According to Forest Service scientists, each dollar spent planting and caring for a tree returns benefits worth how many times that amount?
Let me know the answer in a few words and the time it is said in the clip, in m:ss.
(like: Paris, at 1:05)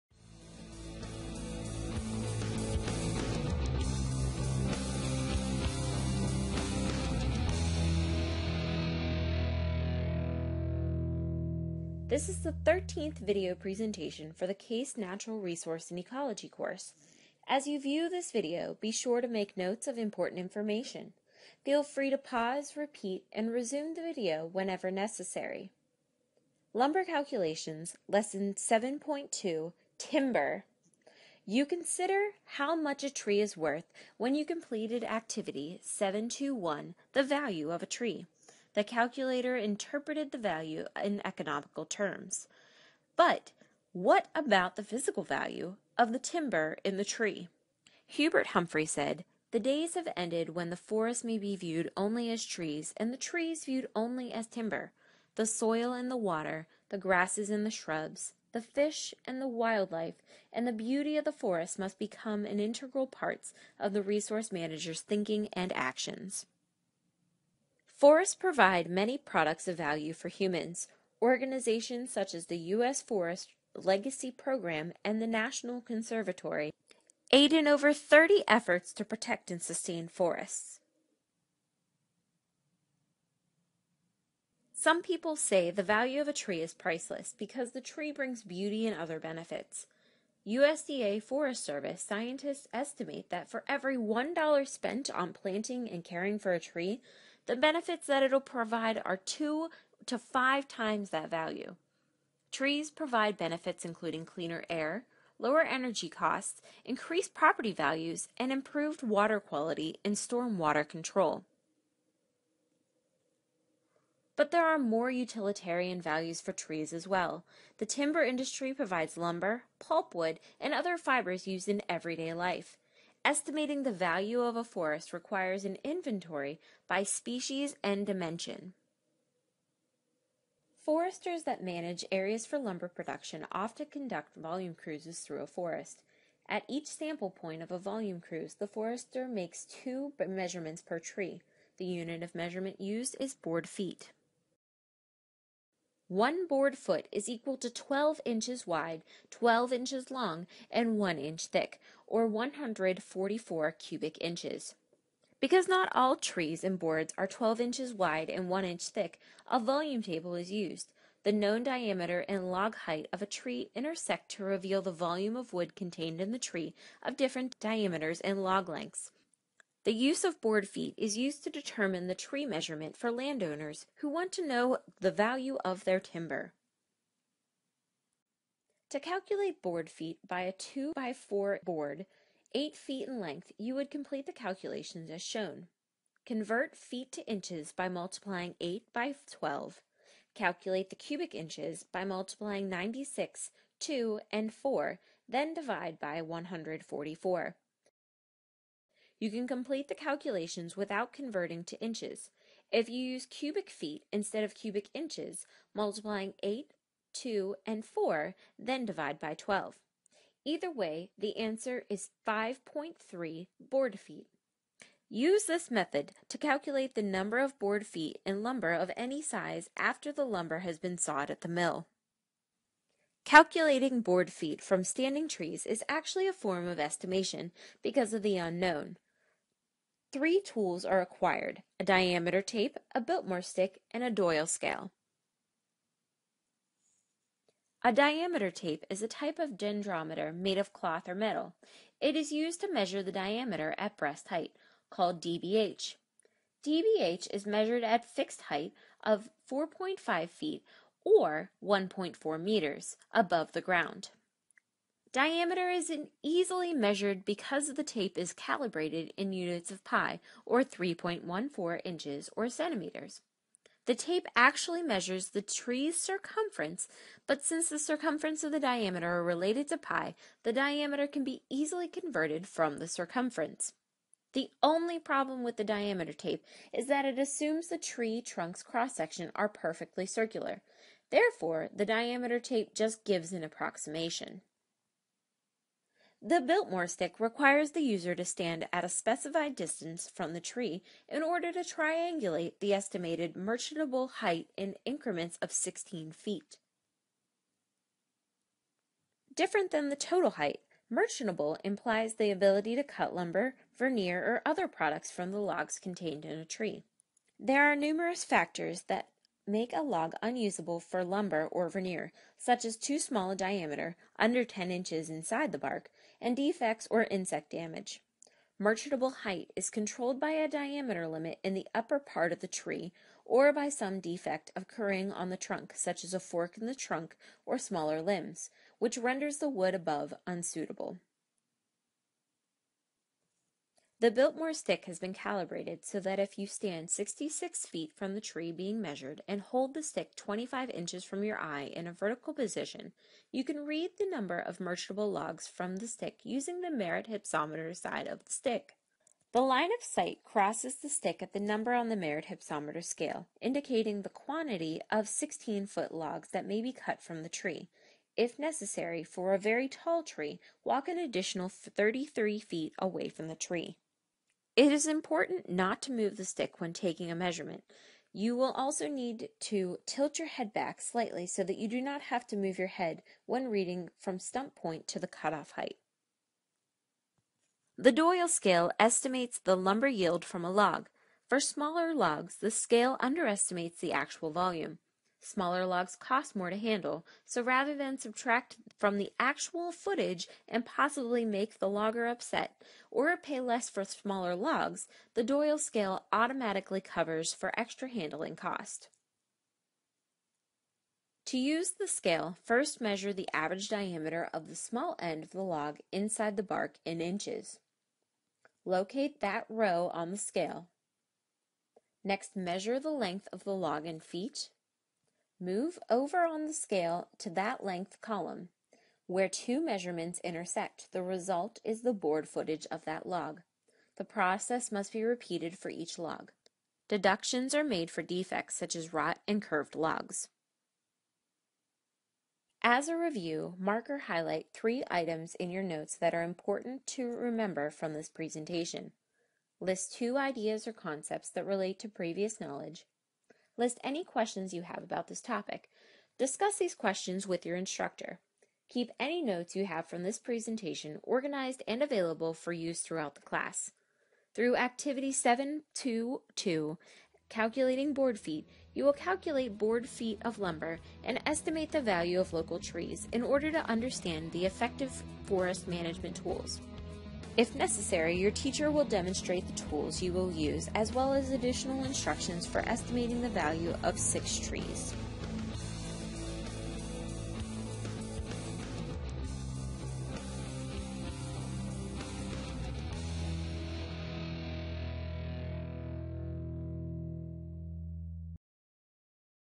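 2 to 5, at 1:39.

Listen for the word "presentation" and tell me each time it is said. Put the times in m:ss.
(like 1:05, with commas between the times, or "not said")
0:13, 7:18, 7:30.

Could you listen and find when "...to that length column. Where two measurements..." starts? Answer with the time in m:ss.
6:57.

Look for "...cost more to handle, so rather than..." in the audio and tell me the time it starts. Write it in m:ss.
6:25.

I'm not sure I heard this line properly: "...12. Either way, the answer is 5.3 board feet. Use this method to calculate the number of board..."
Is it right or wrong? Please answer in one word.
right.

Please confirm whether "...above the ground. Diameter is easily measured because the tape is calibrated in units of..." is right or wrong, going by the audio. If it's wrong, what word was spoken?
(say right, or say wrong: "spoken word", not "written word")
right.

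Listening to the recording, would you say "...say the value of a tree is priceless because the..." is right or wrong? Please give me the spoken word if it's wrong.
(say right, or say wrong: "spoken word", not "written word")
right.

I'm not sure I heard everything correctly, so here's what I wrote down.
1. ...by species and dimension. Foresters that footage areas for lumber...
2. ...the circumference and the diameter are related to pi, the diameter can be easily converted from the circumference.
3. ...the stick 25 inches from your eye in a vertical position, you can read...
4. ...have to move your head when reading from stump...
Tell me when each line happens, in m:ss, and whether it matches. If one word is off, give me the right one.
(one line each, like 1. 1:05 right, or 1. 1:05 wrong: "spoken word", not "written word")
1. 2:06 wrong: "manage", not "footage"
2. 4:27 right
3. 5:39 right
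4. 6:12 right.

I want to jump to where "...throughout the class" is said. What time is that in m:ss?
7:32.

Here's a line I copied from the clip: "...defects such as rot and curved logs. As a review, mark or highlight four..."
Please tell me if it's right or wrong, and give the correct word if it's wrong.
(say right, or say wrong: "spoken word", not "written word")
wrong: "three", not "four".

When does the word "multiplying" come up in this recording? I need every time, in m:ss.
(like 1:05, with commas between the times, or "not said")
3:07, 3:12, 3:25.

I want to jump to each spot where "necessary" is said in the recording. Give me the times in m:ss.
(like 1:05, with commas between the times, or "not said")
0:24, 5:58, 7:47.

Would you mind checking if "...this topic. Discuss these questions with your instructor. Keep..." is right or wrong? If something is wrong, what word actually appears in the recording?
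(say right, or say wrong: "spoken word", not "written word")
right.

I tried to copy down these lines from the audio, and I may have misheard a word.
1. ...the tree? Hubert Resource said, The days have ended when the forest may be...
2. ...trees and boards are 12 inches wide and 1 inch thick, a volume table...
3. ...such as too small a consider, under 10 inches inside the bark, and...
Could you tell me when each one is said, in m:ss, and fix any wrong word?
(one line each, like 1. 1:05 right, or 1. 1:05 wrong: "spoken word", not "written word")
1. 0:46 wrong: "Humphrey", not "Resource"
2. 2:36 right
3. 5:12 wrong: "diameter", not "consider".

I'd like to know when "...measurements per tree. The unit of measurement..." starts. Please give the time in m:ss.
2:20.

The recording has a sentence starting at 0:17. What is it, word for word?
As you view this video, be sure to make notes of important information.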